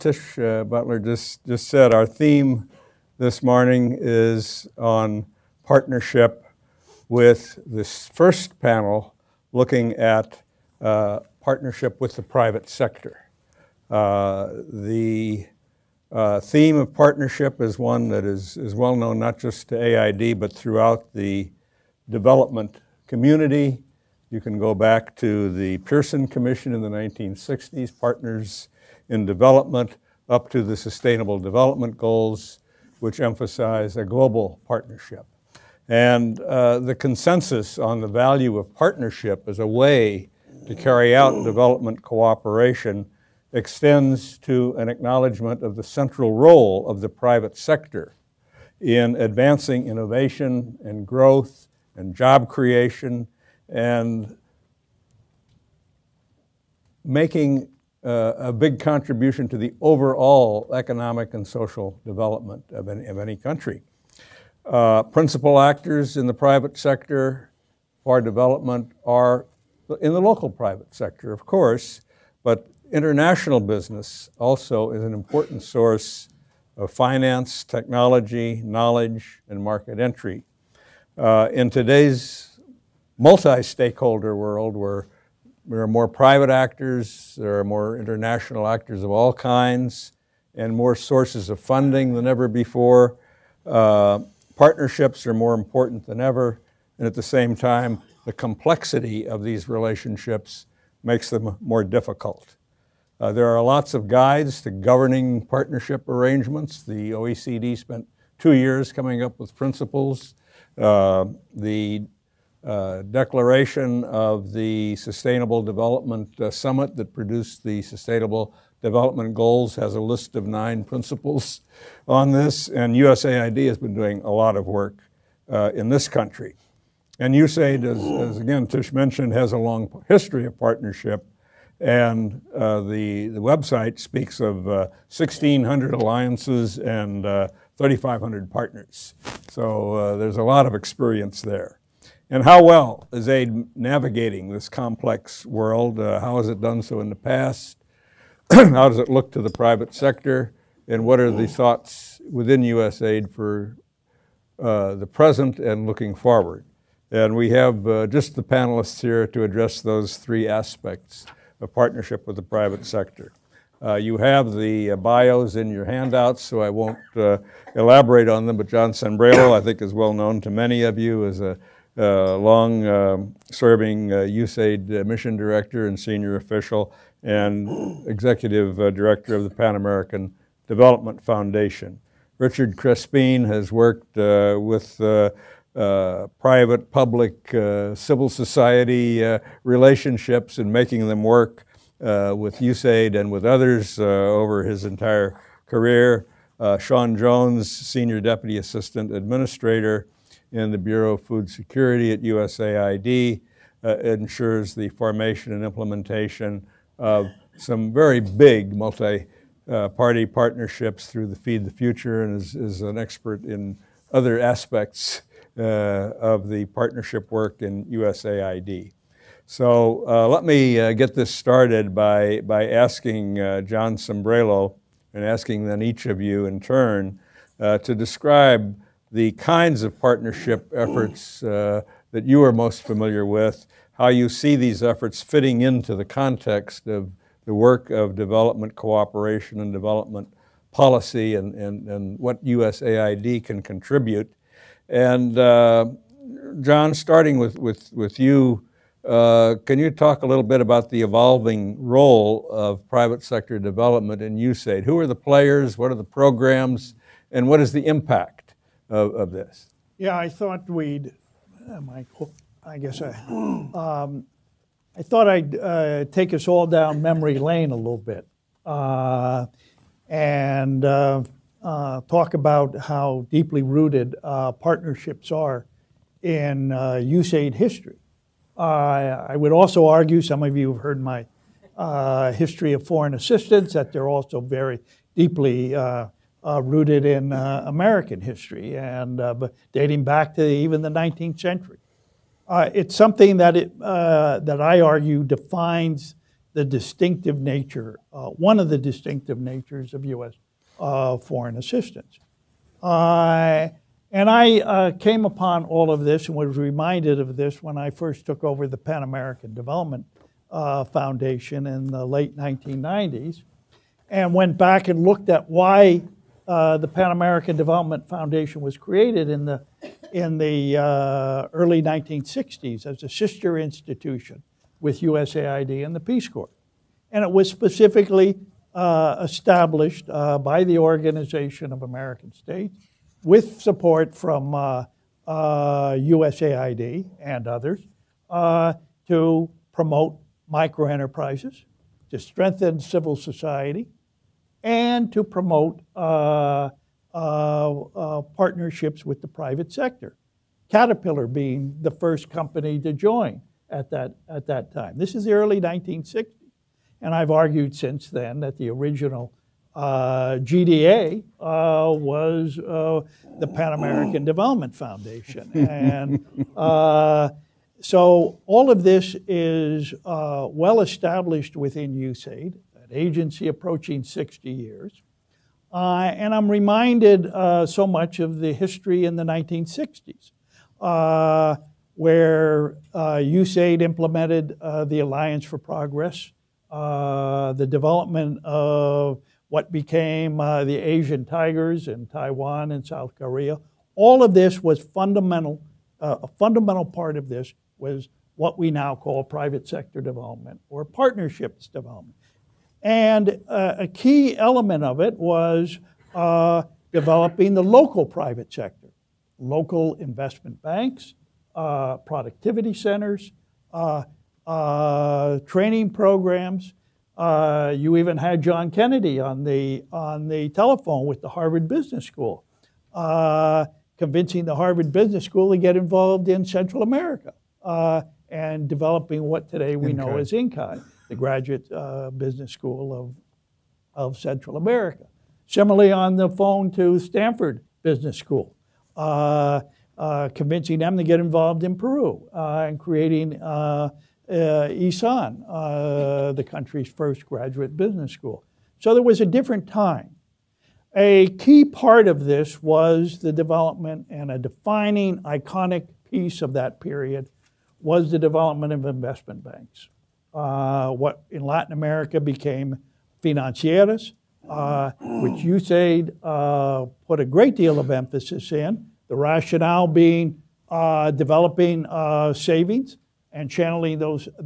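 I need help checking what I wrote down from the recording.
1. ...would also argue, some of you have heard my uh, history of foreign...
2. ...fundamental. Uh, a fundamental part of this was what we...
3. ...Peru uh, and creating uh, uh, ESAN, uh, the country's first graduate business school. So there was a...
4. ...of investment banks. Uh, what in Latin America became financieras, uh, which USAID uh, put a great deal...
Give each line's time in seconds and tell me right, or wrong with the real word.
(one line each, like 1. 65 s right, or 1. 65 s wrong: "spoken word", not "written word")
1. 279 s right
2. 394 s right
3. 441 s right
4. 458 s right.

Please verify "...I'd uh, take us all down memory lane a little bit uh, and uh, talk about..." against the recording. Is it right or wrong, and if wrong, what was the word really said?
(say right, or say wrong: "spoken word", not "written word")
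right.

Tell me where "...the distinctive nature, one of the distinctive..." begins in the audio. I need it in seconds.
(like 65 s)
296 s.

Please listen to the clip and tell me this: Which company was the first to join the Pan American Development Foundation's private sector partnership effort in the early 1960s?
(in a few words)
Caterpillar.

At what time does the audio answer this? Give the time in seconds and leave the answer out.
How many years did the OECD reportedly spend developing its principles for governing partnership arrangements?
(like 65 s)
108 s.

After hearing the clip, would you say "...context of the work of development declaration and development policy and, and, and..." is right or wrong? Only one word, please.
wrong.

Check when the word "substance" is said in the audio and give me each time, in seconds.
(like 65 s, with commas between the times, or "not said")
not said.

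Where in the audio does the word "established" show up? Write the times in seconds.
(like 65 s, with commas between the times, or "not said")
329 s, 370 s.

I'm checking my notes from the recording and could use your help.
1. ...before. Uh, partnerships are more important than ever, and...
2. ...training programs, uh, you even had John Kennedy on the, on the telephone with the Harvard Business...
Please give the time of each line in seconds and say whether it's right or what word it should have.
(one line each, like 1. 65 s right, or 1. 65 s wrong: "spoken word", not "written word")
1. 92 s right
2. 415 s right.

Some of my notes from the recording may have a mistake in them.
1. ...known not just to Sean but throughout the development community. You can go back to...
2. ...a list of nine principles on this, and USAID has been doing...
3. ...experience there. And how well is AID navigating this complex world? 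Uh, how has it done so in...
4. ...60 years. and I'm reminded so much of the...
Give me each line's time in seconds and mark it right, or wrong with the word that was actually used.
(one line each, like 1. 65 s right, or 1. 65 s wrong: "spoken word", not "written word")
1. 18 s wrong: "AID", not "Sean"
2. 119 s right
3. 140 s right
4. 374 s right.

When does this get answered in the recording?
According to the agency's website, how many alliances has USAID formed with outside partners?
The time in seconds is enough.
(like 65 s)
135 s.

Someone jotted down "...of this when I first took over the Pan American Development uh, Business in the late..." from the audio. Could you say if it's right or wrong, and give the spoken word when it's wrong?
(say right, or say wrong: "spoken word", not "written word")
wrong: "Foundation", not "Business".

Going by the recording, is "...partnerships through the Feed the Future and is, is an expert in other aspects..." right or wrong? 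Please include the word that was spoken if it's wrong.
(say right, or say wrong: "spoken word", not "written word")
right.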